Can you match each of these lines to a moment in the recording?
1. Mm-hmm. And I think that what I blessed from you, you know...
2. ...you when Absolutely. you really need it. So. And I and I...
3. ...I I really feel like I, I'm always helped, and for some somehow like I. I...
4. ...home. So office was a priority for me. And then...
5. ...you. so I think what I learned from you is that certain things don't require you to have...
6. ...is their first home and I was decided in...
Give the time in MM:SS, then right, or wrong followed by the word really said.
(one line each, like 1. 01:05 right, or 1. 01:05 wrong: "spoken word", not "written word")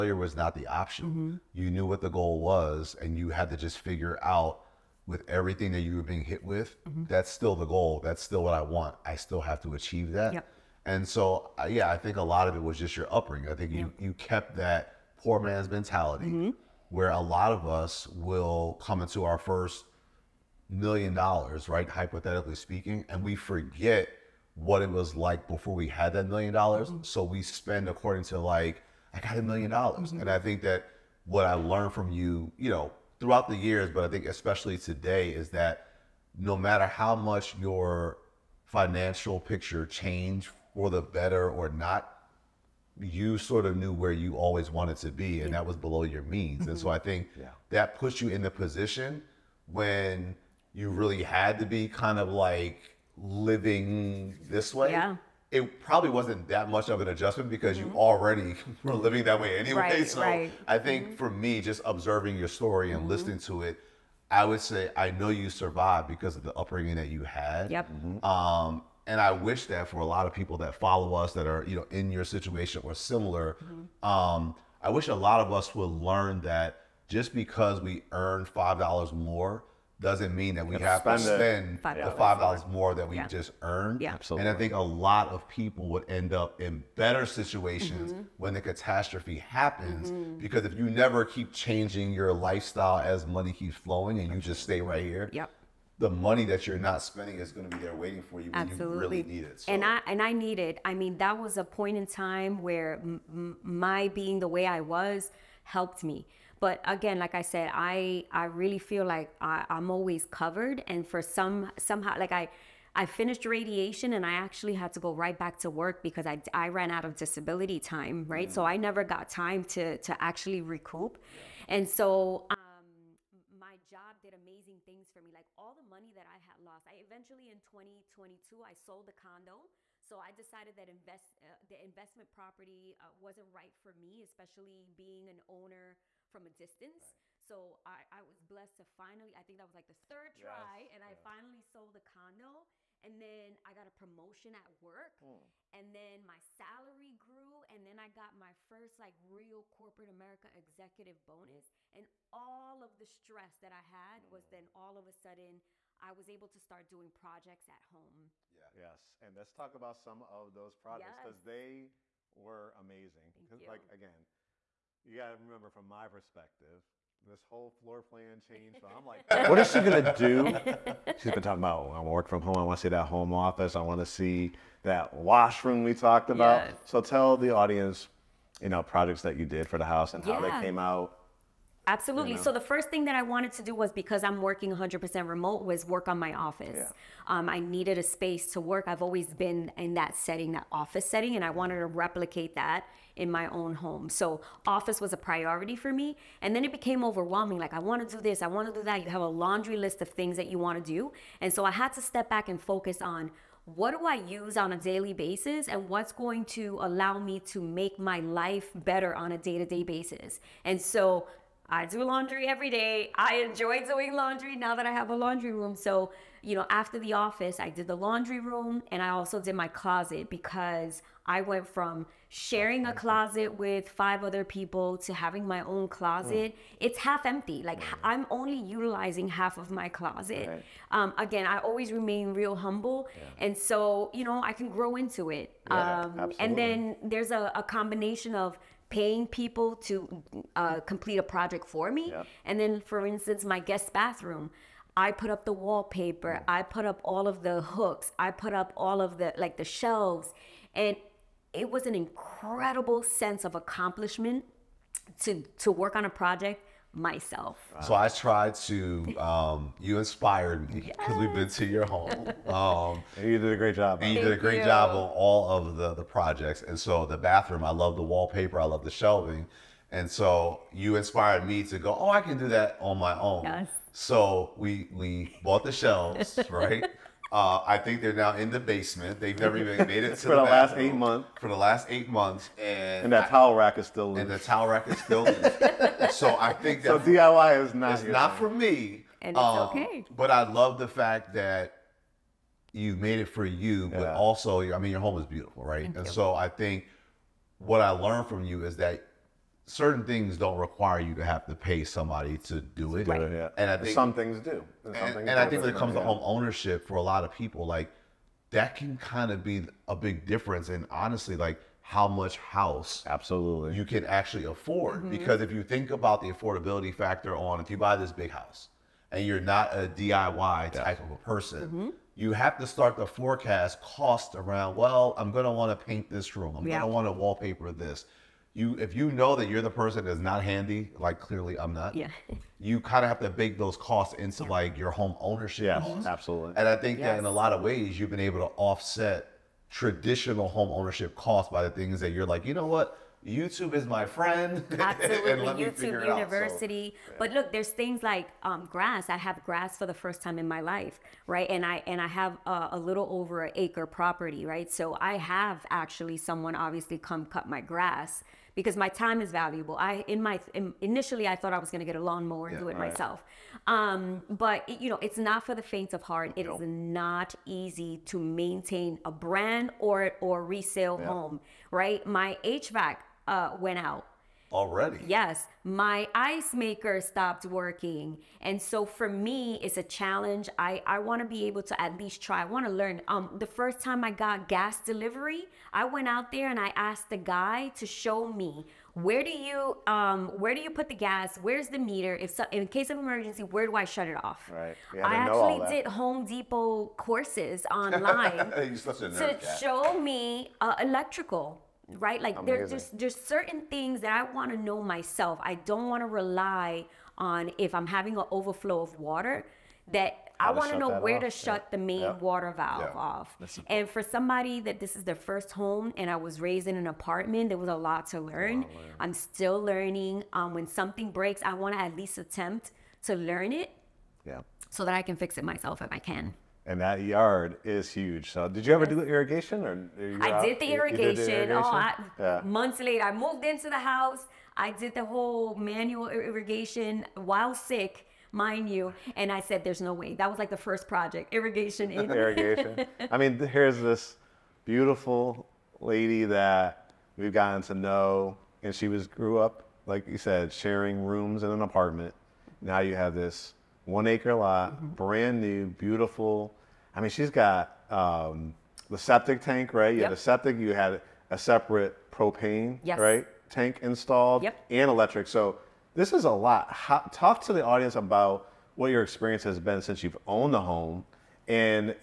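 1. 00:30 wrong: "learned", not "blessed"
2. 01:38 right
3. 01:47 wrong: "covered", not "helped"
4. 03:13 right
5. 04:56 right
6. 06:54 wrong: "raised", not "decided".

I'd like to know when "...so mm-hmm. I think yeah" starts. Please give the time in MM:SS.
00:46.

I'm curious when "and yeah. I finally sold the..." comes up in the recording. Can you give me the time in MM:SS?
02:20.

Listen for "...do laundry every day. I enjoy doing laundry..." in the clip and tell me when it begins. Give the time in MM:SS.
03:31.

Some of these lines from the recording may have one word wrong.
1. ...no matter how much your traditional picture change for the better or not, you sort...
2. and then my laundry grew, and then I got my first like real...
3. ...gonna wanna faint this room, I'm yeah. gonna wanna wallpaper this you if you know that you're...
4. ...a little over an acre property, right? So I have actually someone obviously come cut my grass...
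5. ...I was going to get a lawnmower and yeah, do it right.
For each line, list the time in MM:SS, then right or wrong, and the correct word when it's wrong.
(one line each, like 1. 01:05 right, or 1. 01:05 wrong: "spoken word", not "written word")
1. 00:36 wrong: "financial", not "traditional"
2. 02:25 wrong: "salary", not "laundry"
3. 05:25 wrong: "paint", not "faint"
4. 05:52 right
5. 06:01 right.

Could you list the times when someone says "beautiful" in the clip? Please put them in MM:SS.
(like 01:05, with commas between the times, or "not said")
04:55, 07:24, 07:35.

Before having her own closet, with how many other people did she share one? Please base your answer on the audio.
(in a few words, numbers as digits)
5.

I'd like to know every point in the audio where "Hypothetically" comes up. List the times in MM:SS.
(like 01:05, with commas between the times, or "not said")
00:21.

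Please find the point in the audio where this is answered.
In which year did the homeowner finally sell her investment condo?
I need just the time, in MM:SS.
02:07.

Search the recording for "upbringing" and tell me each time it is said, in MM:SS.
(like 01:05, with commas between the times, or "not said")
00:13, 01:06.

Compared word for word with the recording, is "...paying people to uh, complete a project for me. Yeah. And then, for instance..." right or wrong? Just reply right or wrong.
right.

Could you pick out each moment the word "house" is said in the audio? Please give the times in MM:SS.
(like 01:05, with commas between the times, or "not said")
02:59, 05:12, 05:18, 07:13.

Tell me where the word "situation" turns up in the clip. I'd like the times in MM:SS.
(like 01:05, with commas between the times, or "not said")
01:12, 01:27.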